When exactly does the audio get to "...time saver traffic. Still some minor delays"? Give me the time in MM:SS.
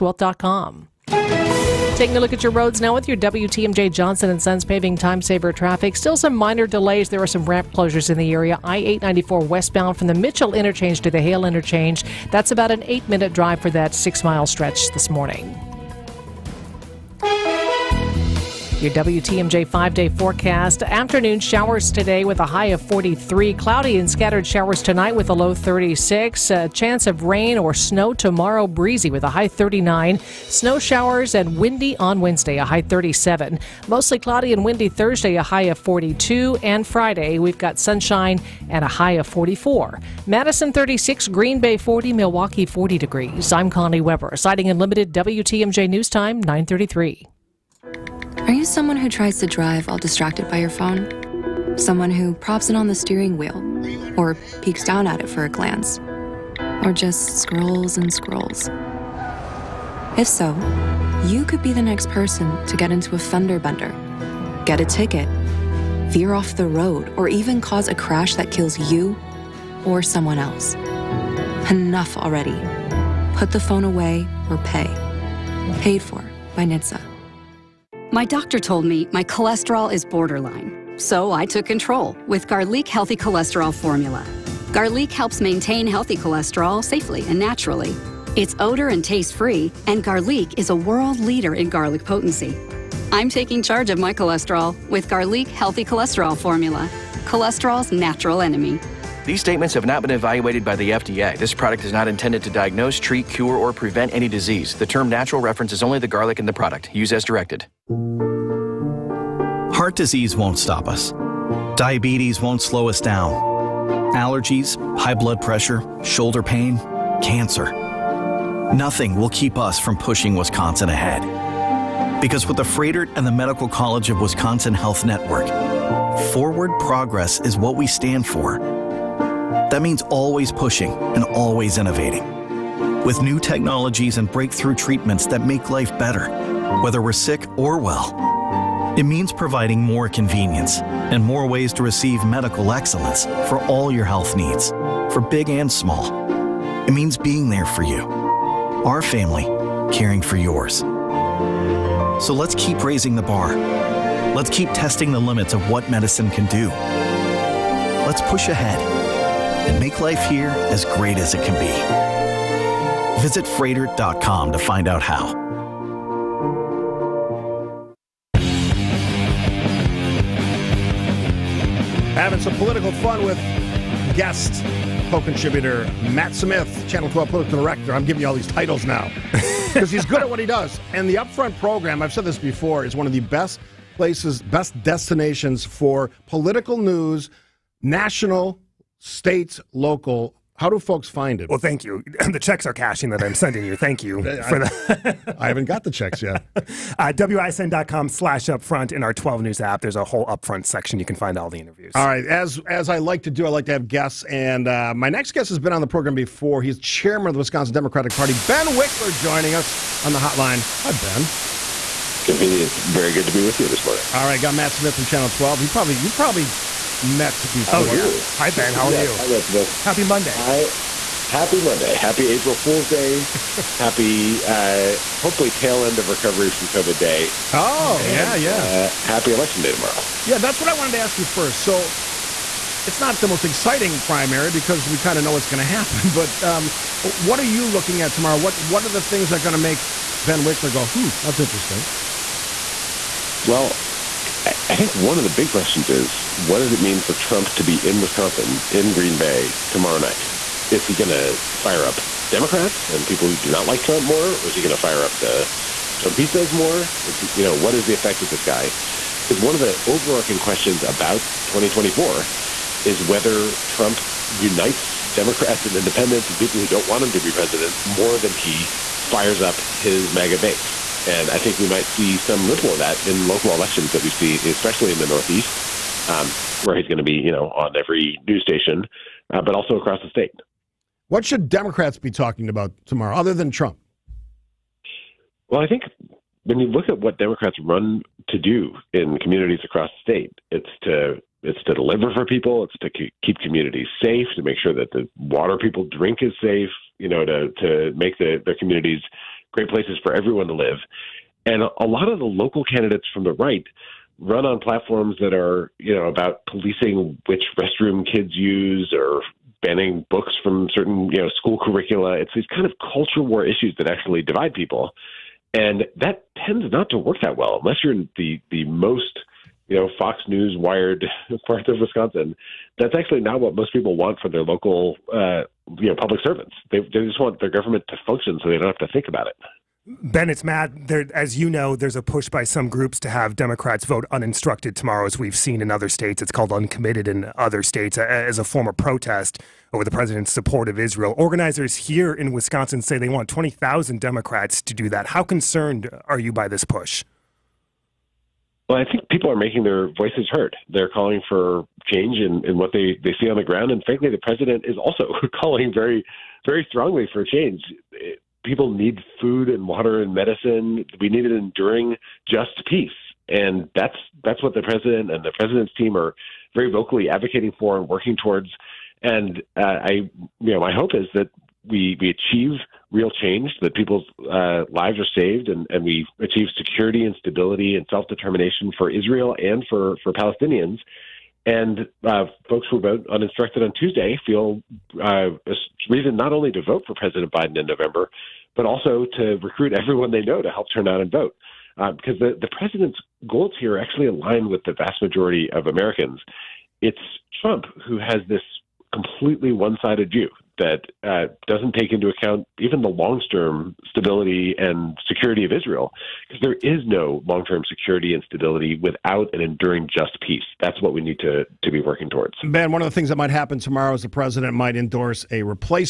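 00:04.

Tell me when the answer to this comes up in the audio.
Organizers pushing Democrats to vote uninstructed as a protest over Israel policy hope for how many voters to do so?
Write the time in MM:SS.
05:43.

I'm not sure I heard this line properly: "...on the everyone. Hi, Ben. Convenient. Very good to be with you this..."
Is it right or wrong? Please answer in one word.
wrong.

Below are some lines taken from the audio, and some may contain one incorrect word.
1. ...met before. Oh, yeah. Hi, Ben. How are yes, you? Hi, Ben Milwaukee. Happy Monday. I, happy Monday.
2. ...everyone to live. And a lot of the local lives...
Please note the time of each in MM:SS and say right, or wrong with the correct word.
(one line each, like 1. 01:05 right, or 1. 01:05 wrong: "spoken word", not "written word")
1. 03:37 wrong: "Smith", not "Milwaukee"
2. 05:00 wrong: "candidates", not "lives".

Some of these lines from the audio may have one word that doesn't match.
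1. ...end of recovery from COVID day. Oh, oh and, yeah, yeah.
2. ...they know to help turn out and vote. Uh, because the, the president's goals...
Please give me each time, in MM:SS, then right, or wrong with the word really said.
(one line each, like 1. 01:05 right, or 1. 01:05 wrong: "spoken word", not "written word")
1. 03:45 right
2. 06:30 right.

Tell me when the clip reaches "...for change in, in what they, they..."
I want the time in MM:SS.
05:51.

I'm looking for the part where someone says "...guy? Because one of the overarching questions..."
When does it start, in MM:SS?
04:18.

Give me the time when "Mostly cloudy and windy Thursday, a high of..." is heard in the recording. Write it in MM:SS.
00:33.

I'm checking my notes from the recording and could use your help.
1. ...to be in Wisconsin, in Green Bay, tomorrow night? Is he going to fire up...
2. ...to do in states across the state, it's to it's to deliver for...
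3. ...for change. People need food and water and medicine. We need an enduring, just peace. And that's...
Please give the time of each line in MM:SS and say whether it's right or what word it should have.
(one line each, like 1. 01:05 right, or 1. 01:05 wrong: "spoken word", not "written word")
1. 04:07 right
2. 04:48 wrong: "communities", not "states"
3. 05:57 right.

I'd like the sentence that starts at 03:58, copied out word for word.
What What are the things that are going to make Ben Wikler go, hmm, that's interesting?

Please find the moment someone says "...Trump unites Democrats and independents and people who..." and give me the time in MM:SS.
04:23.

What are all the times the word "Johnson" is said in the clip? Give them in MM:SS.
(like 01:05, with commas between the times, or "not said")
00:03.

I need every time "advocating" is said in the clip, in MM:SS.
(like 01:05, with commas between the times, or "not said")
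06:07.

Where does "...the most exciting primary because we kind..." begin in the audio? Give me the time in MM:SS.
03:53.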